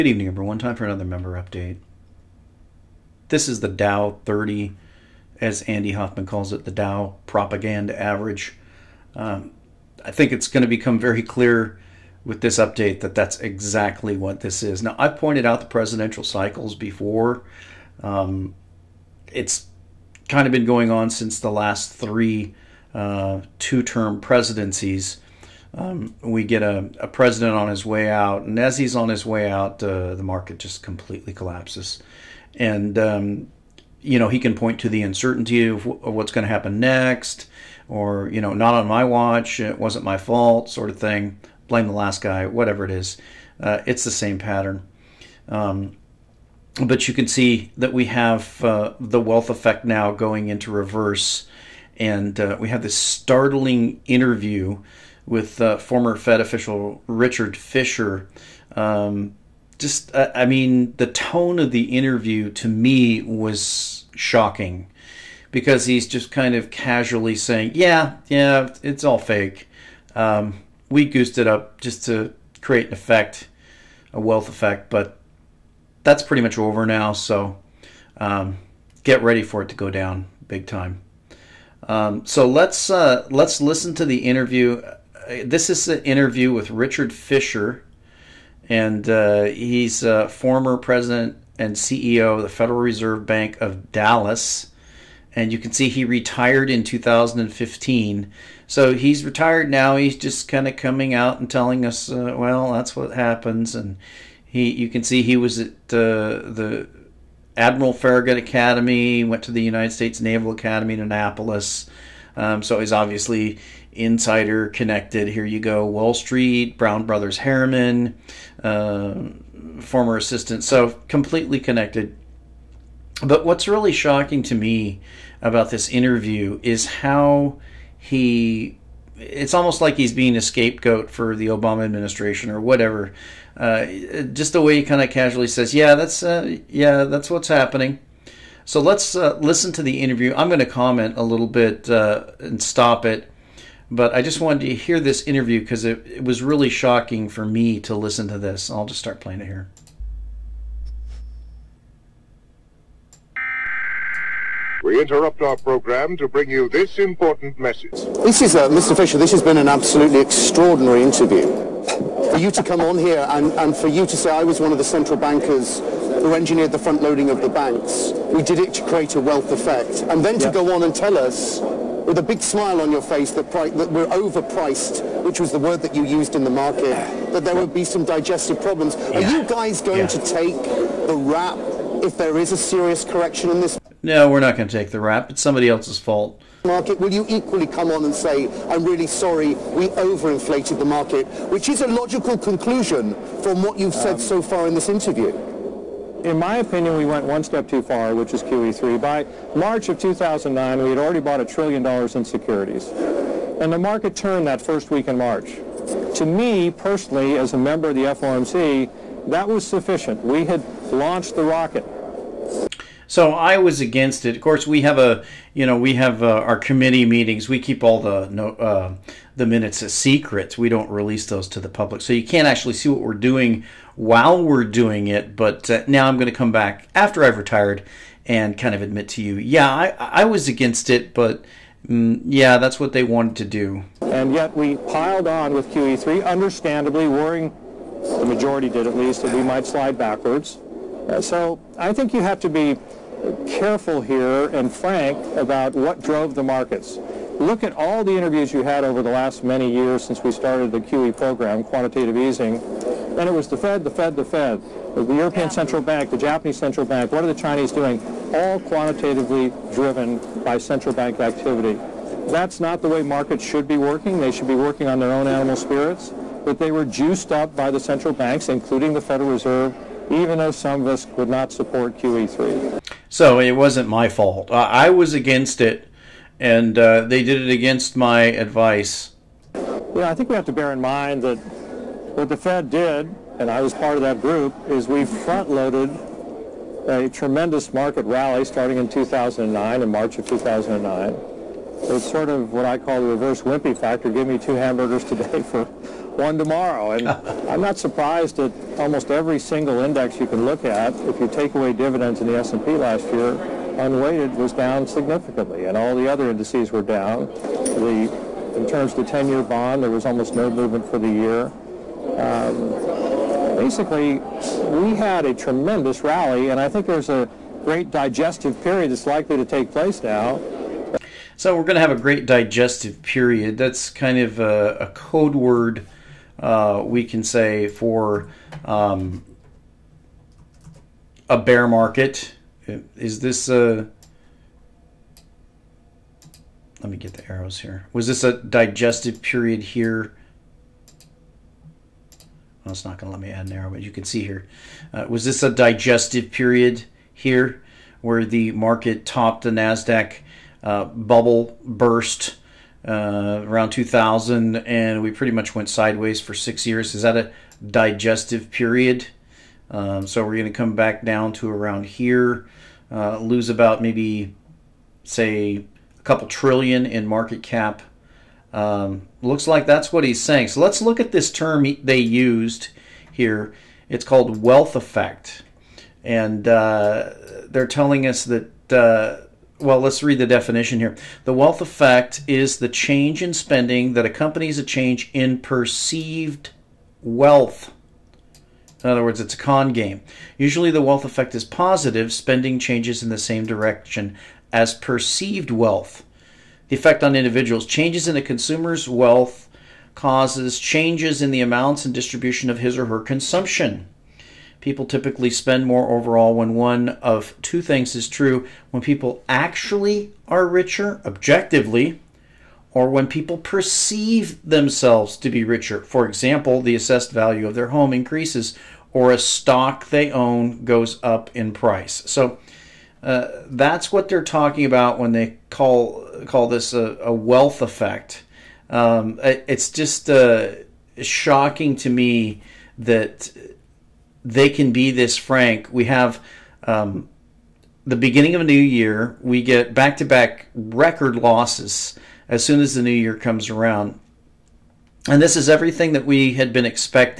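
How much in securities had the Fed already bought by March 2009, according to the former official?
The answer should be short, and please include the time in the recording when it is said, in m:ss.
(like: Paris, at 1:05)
a trillion dollars, at 3:21.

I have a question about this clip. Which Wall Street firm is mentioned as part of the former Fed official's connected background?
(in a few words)
Brown Brothers Harriman.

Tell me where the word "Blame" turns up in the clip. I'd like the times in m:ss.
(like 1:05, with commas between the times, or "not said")
0:41.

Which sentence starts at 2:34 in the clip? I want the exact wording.
We interrupt our program to bring you this important message.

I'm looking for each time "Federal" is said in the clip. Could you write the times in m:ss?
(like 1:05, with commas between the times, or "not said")
1:32, 4:29.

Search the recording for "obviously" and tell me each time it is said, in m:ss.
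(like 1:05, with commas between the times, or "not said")
1:52.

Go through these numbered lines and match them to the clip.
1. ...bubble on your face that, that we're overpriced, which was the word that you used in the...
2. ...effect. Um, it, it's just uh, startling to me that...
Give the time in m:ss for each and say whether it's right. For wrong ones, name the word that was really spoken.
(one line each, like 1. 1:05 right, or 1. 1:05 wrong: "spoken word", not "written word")
1. 2:52 wrong: "smile", not "bubble"
2. 7:07 wrong: "shocking", not "startling".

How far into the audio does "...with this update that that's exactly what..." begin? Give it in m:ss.
0:12.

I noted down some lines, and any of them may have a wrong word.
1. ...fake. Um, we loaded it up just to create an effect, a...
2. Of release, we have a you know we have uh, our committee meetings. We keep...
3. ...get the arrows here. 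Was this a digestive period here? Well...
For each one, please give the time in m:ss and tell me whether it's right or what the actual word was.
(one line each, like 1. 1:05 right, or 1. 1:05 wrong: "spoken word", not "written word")
1. 1:09 wrong: "goosed", not "loaded"
2. 3:34 wrong: "course", not "release"
3. 5:36 right.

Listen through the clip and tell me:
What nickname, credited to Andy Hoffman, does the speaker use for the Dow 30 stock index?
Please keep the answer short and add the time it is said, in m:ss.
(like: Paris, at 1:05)
Dow propaganda average, at 0:06.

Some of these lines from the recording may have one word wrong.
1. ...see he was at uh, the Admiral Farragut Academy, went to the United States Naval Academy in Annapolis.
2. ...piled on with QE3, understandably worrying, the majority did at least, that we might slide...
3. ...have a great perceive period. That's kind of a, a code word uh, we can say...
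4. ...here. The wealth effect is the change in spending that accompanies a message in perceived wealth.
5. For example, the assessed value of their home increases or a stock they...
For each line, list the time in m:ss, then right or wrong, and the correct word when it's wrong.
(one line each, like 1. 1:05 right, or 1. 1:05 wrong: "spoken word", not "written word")
1. 1:45 right
2. 3:54 right
3. 5:21 wrong: "digestive", not "perceive"
4. 6:20 wrong: "change", not "message"
5. 6:55 right.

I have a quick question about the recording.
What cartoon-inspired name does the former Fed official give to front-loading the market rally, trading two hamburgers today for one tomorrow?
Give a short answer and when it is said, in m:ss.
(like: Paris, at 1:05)
reverse wimpy factor, at 4:53.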